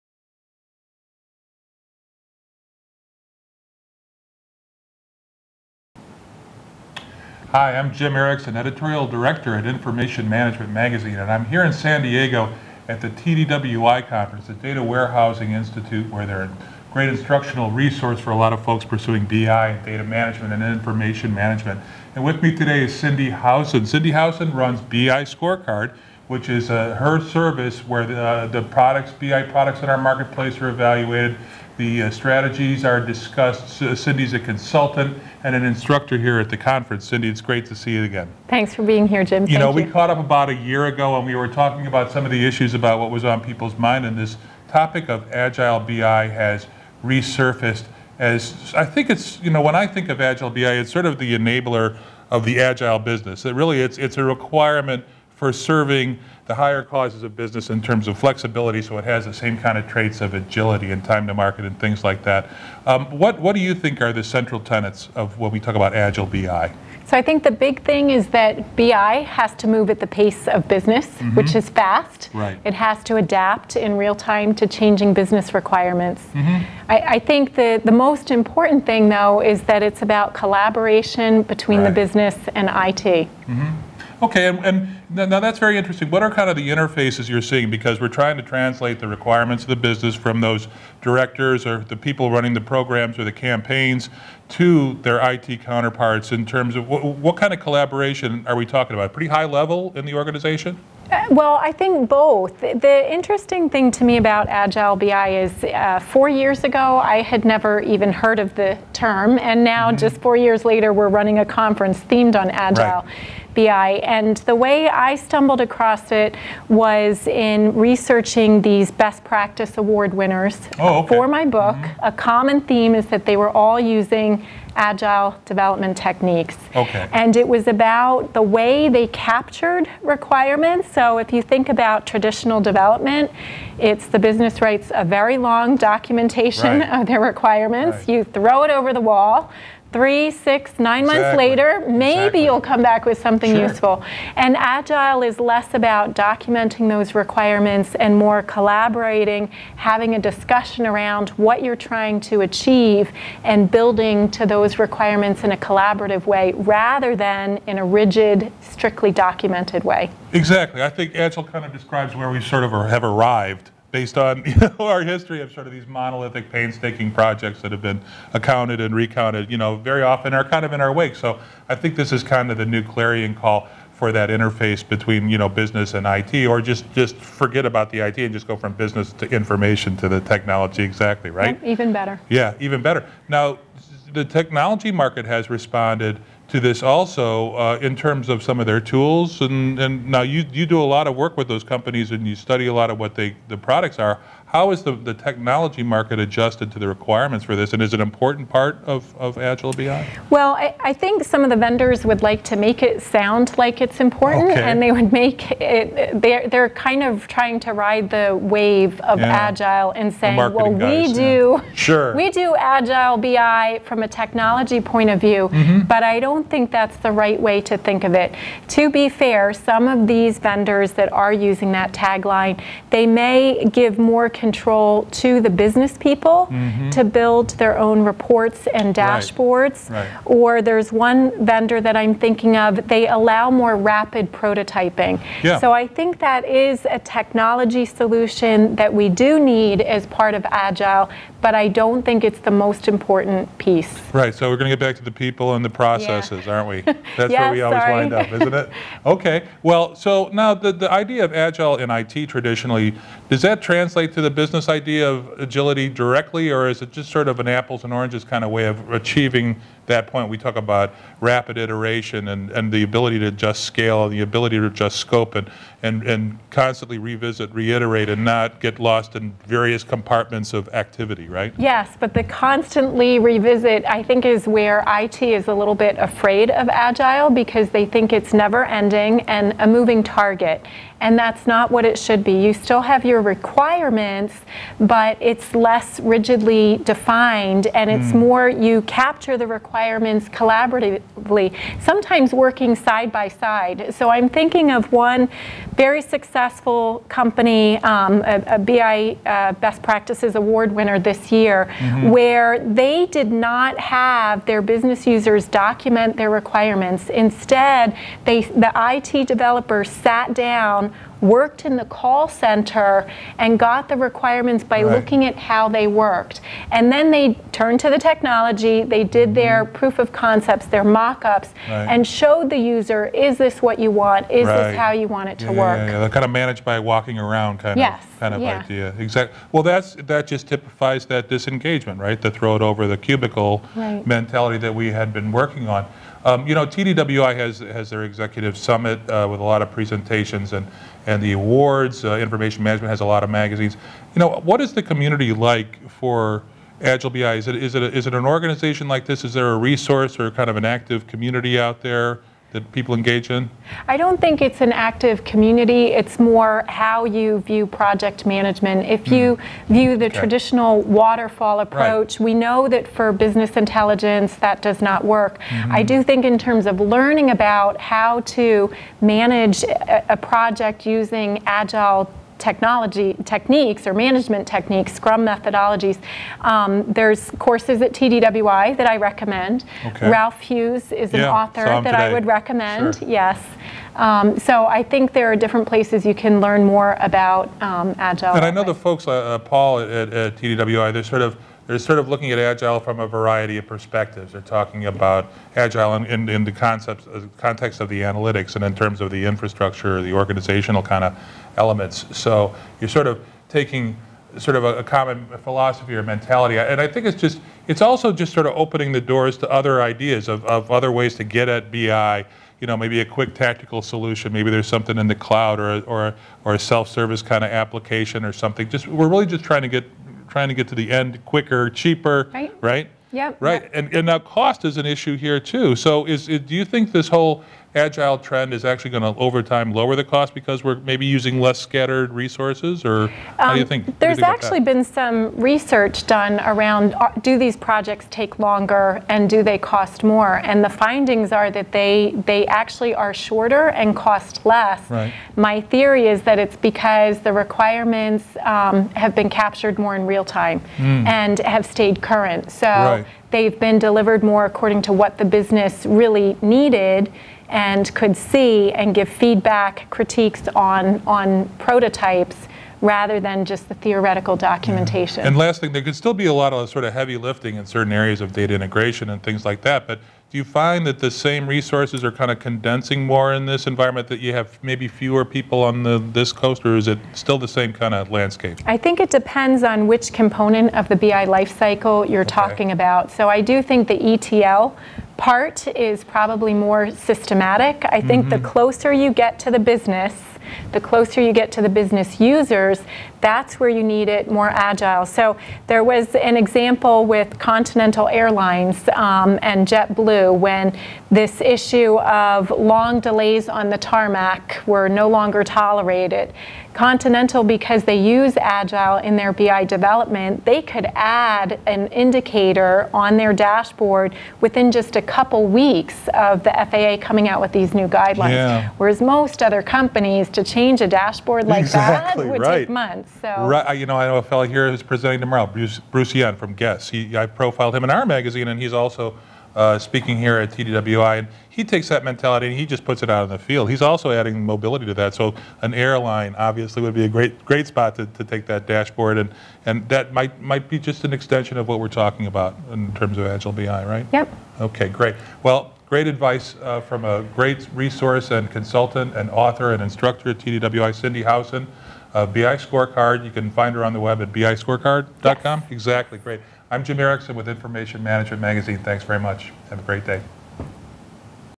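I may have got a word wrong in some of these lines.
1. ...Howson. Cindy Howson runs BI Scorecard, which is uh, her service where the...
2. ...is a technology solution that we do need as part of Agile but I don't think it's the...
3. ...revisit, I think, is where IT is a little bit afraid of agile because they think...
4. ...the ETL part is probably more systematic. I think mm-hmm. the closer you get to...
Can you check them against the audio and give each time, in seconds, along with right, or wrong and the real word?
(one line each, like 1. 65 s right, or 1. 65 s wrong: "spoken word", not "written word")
1. 23 s right
2. 236 s right
3. 273 s right
4. 483 s right.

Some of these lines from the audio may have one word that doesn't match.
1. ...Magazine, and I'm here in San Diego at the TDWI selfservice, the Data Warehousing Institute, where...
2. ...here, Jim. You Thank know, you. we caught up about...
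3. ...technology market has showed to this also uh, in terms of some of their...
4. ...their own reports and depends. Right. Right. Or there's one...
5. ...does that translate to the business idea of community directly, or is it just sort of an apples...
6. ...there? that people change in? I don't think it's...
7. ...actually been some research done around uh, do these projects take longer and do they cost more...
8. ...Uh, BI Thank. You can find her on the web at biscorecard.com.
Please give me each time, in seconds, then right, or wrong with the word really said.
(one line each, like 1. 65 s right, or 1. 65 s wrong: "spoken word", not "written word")
1. 10 s wrong: "conference", not "selfservice"
2. 39 s right
3. 184 s wrong: "responded", not "showed"
4. 227 s wrong: "dashboards", not "depends"
5. 253 s wrong: "agility", not "community"
6. 351 s wrong: "engage", not "change"
7. 434 s right
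8. 552 s wrong: "Scorecard", not "Thank".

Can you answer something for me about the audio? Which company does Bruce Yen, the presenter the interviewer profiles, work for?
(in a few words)
Guess.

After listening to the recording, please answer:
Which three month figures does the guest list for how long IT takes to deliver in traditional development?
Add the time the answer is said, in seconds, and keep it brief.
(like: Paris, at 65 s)
3, 6, 9, at 139 s.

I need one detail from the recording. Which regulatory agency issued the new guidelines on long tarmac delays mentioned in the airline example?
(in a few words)
FAA.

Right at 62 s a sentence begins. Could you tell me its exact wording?
Um, what, what do you think are the central tenets of when we talk about Agile BI?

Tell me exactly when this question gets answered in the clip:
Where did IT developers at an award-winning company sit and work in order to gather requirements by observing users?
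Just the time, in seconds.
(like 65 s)
311 s.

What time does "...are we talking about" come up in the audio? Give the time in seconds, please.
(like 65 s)
98 s.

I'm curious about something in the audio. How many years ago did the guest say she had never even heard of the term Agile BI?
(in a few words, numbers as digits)
4.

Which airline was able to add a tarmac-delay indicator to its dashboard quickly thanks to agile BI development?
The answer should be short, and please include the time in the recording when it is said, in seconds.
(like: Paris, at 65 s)
Continental Airlines, at 497 s.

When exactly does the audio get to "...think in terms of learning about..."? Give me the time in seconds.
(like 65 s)
366 s.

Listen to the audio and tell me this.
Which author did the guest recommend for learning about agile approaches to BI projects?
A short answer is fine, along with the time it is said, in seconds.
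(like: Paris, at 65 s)
Ralph Hughes, at 380 s.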